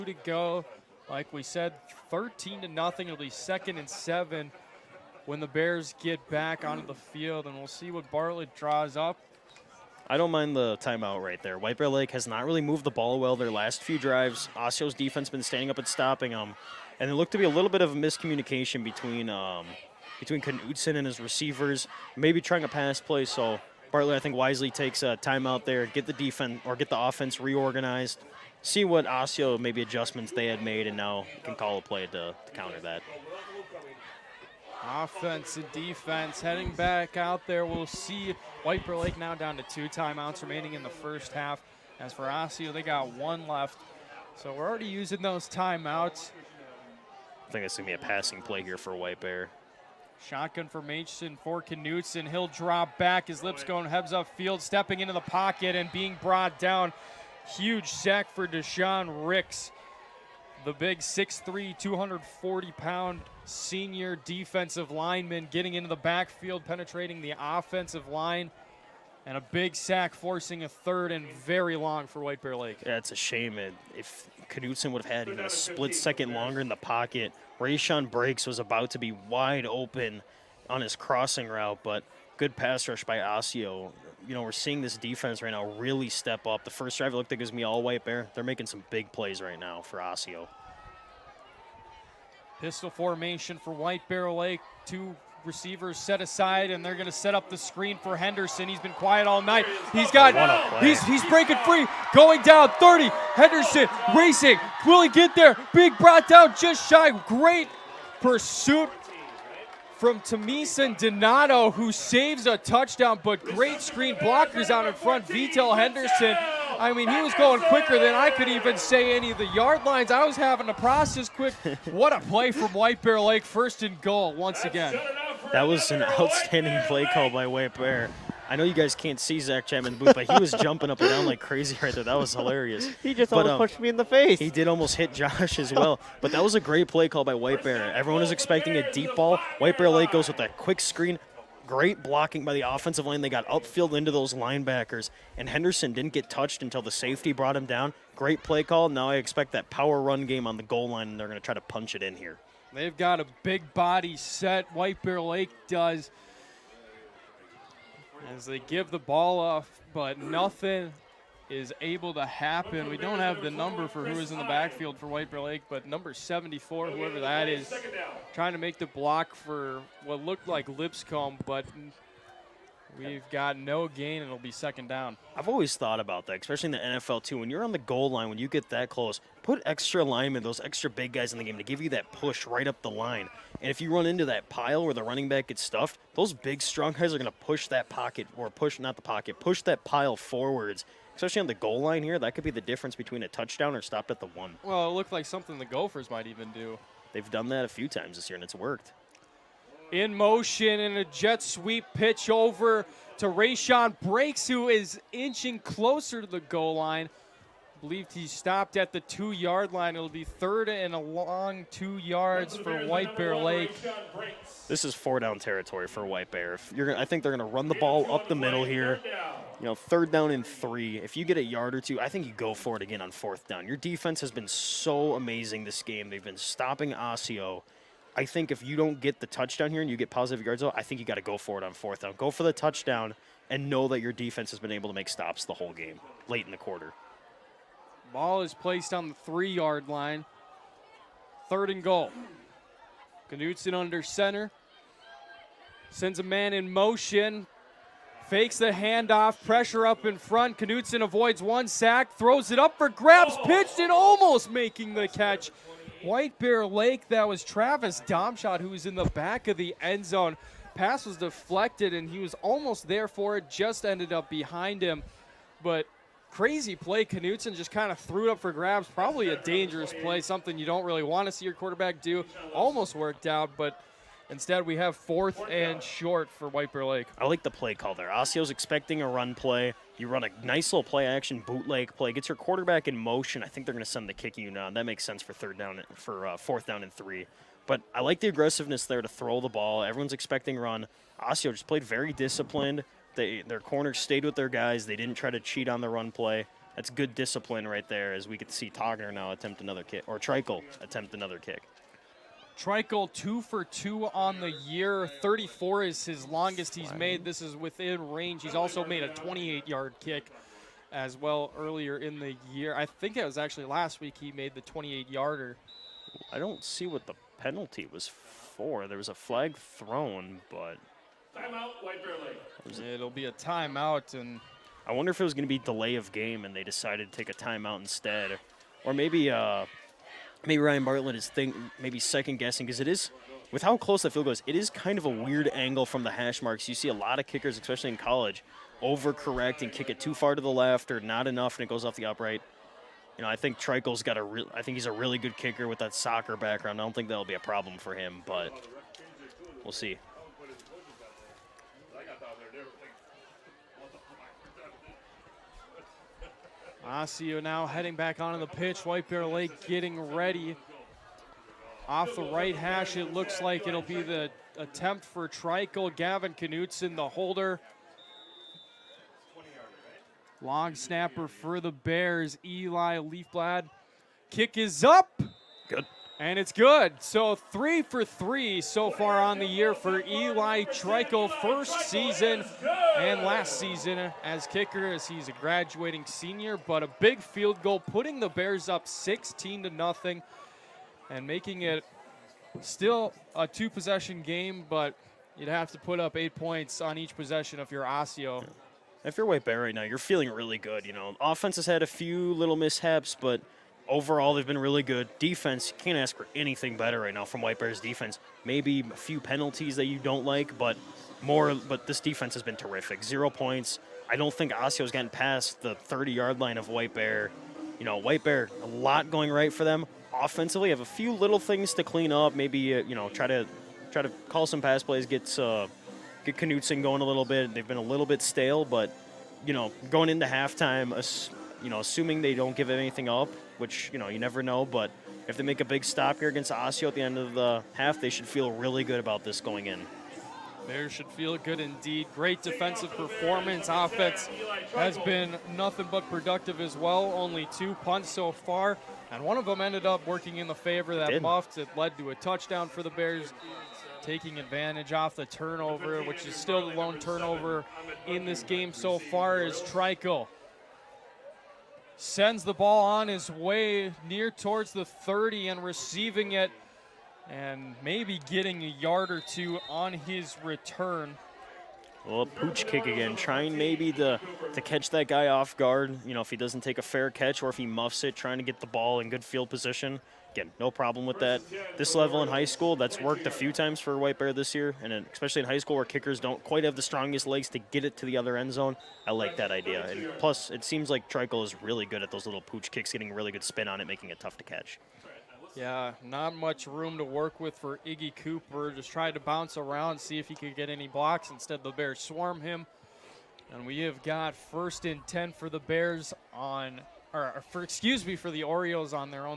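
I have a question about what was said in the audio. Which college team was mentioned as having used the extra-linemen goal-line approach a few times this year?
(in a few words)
Gophers.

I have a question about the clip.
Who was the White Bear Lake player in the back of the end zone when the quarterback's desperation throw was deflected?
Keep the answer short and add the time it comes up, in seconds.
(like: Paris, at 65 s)
Travis Domshot, at 257 s.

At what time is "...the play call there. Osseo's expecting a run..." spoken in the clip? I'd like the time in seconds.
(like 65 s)
277 s.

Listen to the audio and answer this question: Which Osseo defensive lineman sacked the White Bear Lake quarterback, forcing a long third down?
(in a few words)
Deshaun Ricks.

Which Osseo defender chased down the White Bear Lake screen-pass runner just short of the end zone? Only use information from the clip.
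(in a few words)
Tamisen Donato.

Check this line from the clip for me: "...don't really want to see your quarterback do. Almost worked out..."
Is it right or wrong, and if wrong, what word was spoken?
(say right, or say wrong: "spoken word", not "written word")
right.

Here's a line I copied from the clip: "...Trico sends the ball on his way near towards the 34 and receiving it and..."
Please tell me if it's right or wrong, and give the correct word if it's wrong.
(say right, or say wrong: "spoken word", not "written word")
wrong: "30", not "34".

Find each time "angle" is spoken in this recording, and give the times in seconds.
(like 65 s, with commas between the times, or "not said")
335 s.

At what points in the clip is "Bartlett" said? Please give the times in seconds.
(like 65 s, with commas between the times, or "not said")
8 s, 23 s, 330 s.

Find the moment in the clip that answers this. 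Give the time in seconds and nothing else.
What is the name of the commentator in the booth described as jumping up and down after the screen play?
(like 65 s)
129 s.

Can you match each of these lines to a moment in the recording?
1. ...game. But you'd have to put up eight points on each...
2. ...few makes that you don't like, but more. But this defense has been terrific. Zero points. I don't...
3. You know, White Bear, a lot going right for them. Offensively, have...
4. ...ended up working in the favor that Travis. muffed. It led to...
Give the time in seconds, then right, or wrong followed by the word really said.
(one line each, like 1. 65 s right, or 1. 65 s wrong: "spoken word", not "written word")
1. 394 s right
2. 408 s wrong: "penalties", not "makes"
3. 417 s right
4. 449 s wrong: "Did", not "Travis".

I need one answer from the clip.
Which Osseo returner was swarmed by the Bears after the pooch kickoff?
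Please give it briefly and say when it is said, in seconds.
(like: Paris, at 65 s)
Iggy Cooper, at 497 s.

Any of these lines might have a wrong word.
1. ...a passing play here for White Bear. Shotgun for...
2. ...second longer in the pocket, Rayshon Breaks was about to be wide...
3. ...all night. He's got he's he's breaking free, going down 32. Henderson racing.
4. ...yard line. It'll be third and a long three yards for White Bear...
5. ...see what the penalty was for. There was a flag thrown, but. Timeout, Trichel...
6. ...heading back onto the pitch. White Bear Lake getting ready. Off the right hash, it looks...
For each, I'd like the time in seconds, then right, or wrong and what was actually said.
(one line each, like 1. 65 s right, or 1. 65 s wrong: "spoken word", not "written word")
1. 47 s right
2. 75 s right
3. 99 s wrong: "30", not "32"
4. 209 s wrong: "two", not "three"
5. 316 s wrong: "White", not "Trichel"
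6. 357 s right.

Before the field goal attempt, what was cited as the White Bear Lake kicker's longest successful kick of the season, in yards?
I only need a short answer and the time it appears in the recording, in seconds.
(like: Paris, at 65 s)
34, at 305 s.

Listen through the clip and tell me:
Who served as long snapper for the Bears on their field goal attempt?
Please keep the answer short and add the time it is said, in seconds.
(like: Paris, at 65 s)
Eli Leafblad, at 372 s.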